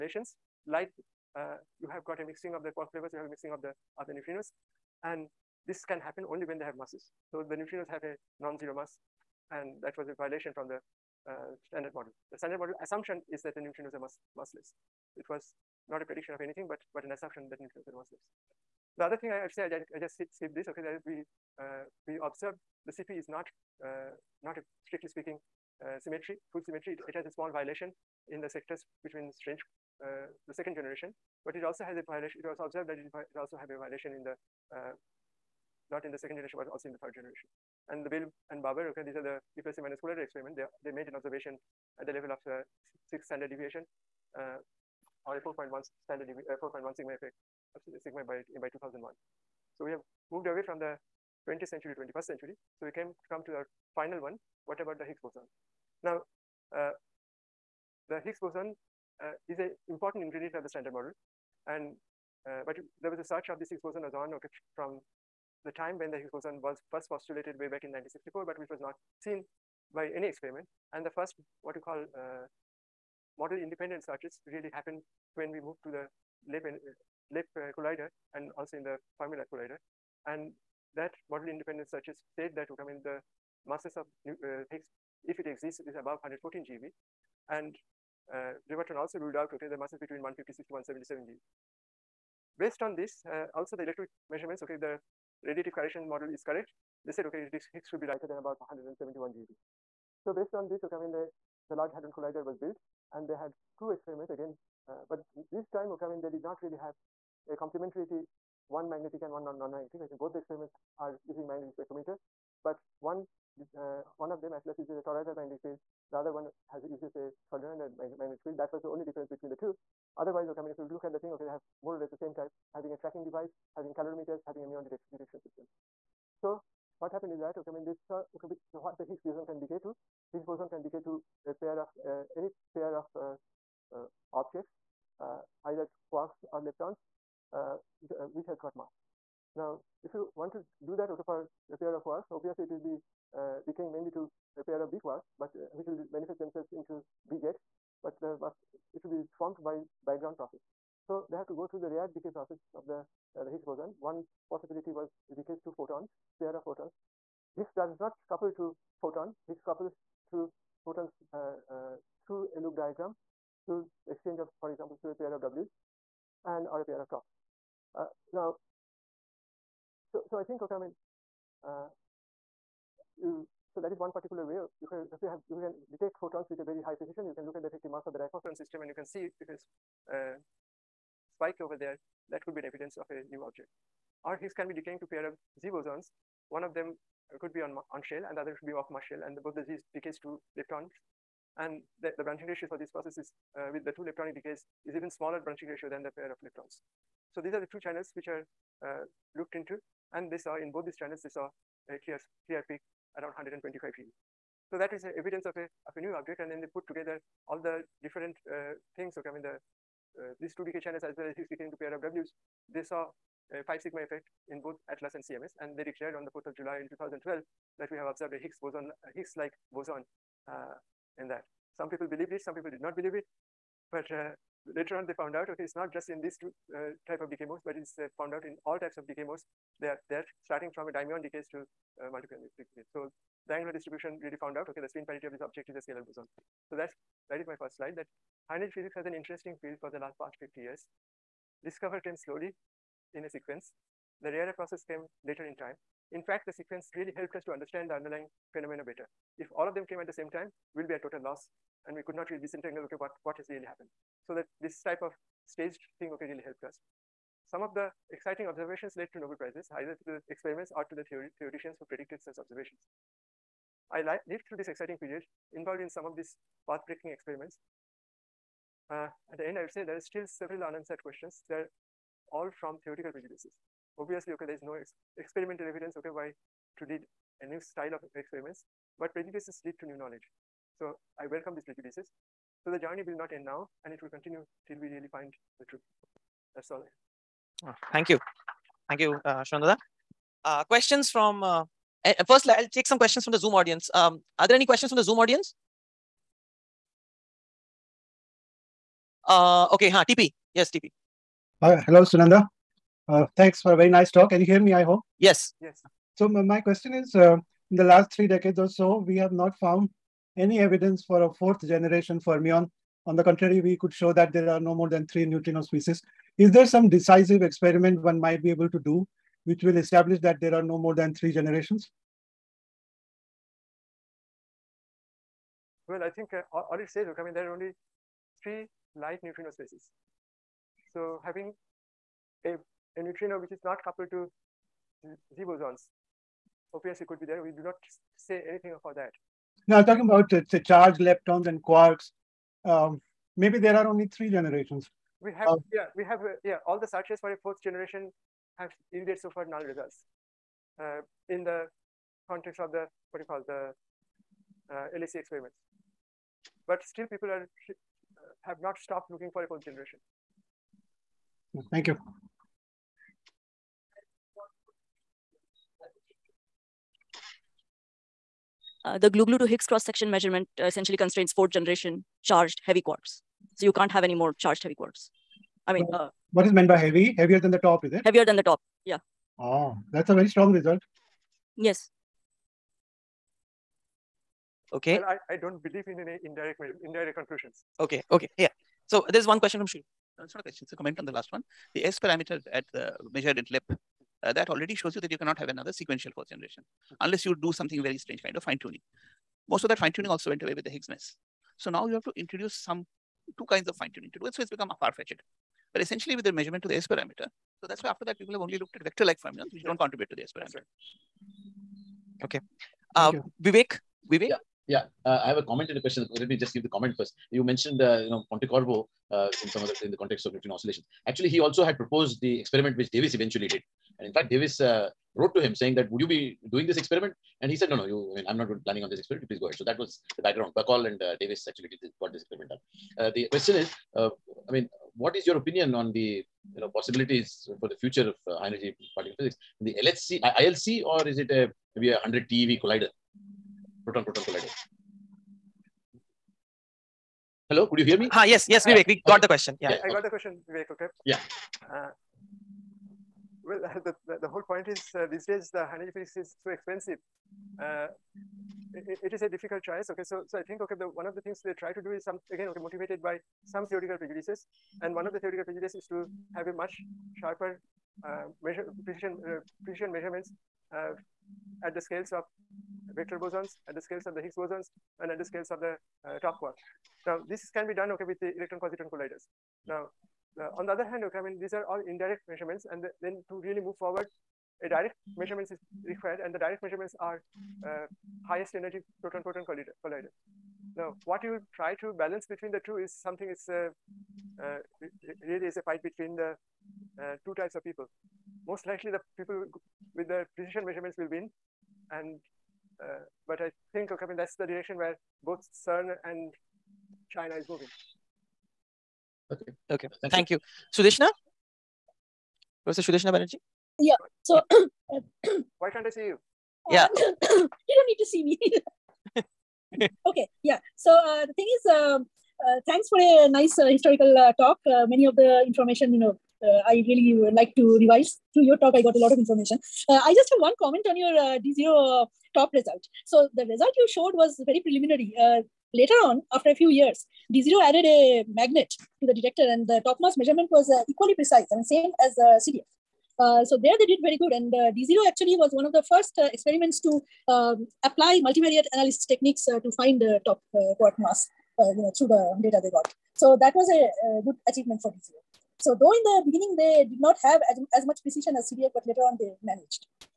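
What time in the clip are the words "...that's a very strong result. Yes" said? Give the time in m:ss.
6:19.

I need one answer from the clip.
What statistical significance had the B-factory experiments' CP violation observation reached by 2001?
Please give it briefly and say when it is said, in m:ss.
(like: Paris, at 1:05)
4.1 sigma, at 0:46.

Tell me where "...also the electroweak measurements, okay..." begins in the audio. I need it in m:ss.
1:33.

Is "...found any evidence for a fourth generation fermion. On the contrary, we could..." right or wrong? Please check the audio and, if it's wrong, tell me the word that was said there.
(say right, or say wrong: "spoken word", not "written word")
right.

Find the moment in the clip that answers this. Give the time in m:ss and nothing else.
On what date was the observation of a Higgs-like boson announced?
3:36.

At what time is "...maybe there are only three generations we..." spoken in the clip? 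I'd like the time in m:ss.
5:43.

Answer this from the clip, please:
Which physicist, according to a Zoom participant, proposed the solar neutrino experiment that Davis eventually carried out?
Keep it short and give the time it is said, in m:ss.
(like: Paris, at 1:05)
Pontecorvo, at 6:58.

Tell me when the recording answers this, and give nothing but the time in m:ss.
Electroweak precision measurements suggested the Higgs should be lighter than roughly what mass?
1:38.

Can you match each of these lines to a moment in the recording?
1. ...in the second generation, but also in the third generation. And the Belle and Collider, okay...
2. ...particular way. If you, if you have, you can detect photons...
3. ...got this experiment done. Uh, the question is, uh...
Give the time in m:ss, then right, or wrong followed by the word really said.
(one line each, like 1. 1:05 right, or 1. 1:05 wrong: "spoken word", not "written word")
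1. 0:36 wrong: "BaBar", not "Collider"
2. 2:54 right
3. 7:12 right.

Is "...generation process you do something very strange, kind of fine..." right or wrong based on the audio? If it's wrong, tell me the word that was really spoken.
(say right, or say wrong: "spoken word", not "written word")
wrong: "unless", not "process".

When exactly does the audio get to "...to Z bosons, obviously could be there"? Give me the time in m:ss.
5:34.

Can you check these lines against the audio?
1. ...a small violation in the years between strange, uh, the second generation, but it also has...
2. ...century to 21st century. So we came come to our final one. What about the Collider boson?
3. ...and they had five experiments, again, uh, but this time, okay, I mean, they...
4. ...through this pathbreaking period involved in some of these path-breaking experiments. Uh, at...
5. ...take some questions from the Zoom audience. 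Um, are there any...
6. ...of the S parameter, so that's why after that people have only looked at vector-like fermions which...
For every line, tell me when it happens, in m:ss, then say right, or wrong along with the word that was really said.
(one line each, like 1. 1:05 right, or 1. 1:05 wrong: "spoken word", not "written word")
1. 0:27 wrong: "sectors", not "years"
2. 0:51 wrong: "Higgs", not "Collider"
3. 1:43 wrong: "two", not "five"
4. 4:24 wrong: "exciting", not "pathbreaking"
5. 4:52 right
6. 6:46 right.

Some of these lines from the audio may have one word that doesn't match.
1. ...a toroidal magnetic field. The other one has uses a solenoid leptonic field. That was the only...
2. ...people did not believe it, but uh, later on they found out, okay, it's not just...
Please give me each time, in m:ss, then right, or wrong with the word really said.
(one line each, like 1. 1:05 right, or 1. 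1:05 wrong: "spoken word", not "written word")
1. 1:54 wrong: "magnetic", not "leptonic"
2. 3:42 right.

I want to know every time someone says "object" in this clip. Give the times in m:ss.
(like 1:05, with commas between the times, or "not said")
2:14, 3:03, 3:26, 3:55.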